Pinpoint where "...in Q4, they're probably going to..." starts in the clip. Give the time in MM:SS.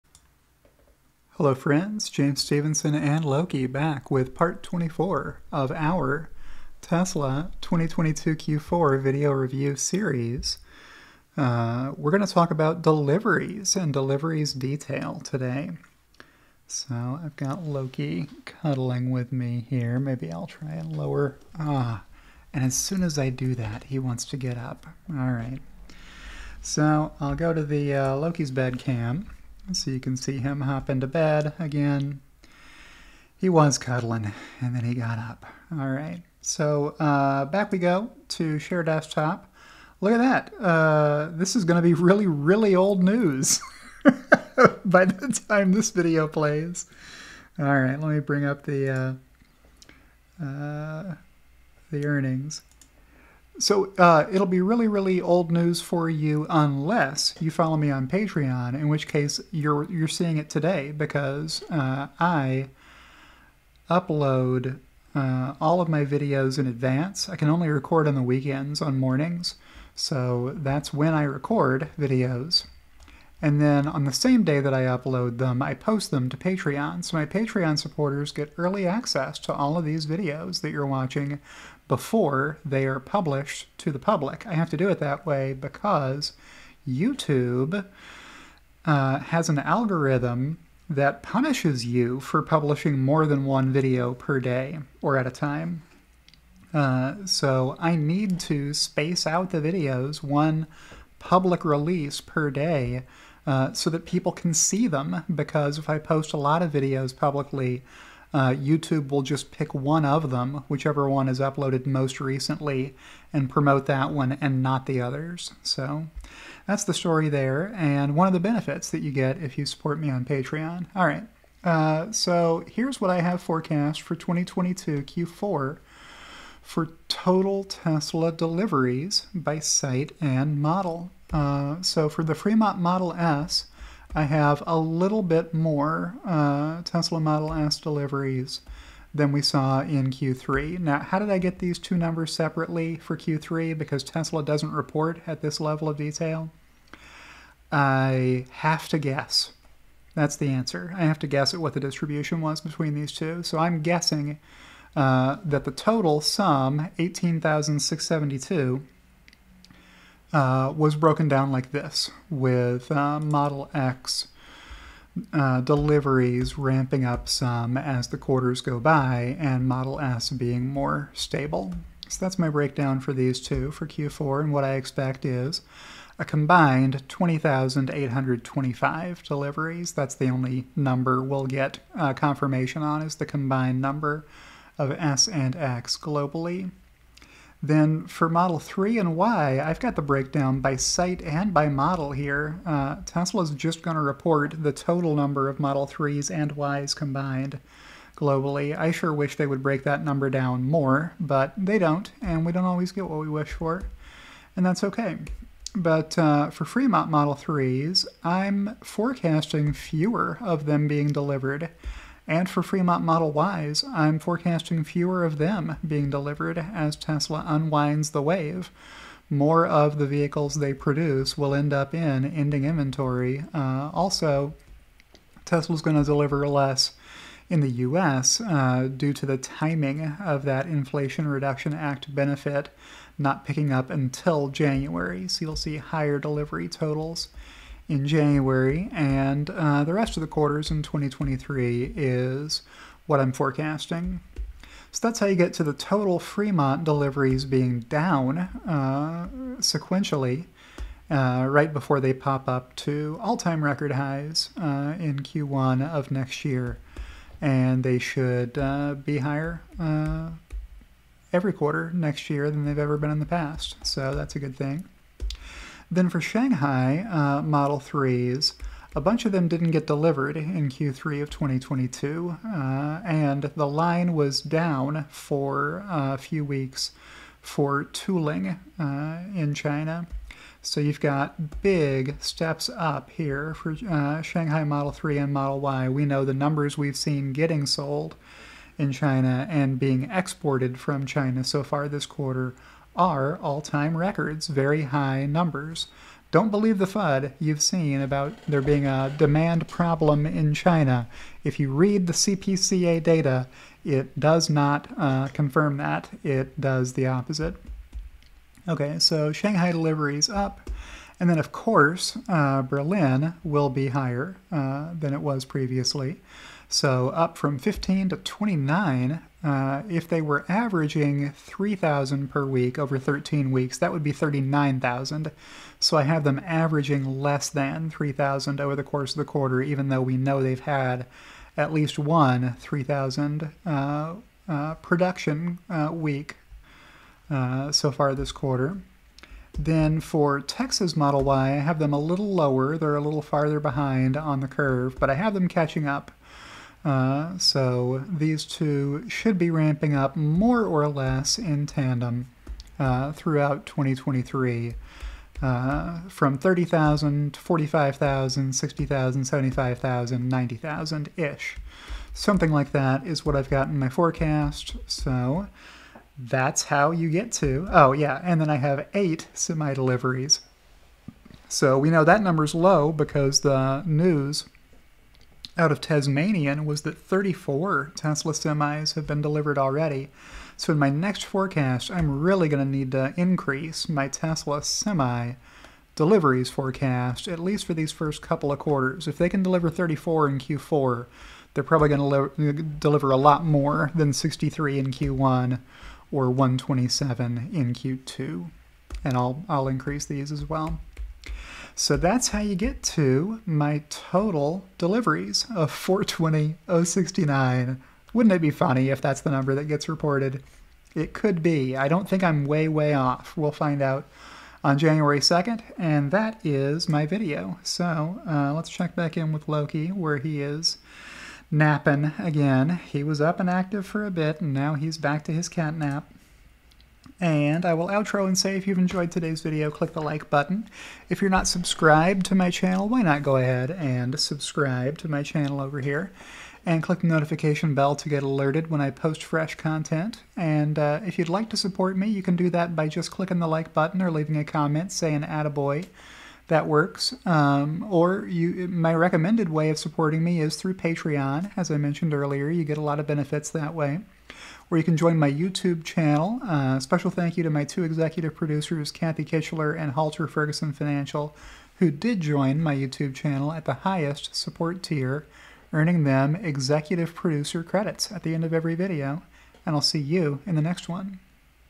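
06:30.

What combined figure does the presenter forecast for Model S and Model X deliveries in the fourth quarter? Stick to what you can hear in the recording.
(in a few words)
20,825.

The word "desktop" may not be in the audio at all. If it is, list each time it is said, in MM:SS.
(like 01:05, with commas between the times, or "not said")
00:38.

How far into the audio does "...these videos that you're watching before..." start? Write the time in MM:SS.
01:19.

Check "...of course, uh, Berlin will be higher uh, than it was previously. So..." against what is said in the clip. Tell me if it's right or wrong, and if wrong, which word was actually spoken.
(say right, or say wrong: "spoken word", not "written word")
right.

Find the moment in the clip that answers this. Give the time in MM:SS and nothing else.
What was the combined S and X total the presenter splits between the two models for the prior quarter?
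02:36.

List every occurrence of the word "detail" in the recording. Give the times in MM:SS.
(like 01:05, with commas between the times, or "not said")
00:14, 02:25.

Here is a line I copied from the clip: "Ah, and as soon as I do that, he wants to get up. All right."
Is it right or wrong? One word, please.
right.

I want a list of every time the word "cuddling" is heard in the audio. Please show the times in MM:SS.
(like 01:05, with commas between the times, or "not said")
00:18, 00:33.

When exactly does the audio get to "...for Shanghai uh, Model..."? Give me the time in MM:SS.
04:26.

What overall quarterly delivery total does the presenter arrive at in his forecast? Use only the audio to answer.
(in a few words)
420,069.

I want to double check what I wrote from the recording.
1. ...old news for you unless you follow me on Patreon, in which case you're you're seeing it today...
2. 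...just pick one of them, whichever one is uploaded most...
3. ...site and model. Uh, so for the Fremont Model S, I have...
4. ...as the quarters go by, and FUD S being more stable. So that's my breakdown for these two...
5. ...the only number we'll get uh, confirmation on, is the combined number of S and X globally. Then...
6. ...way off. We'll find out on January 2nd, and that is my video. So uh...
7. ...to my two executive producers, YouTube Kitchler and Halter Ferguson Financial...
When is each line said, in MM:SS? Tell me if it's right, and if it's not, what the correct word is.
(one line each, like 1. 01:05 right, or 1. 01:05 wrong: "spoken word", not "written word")
1. 00:55 right
2. 01:49 right
3. 02:09 right
4. 02:47 wrong: "Model", not "FUD"
5. 03:00 right
6. 06:52 right
7. 07:37 wrong: "Kathy", not "YouTube".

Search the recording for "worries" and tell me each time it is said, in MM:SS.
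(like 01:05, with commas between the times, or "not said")
not said.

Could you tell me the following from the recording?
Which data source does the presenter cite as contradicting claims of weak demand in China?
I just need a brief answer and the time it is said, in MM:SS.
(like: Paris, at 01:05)
CPCA, at 05:02.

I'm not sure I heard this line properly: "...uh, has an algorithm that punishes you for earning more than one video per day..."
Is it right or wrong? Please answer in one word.
wrong.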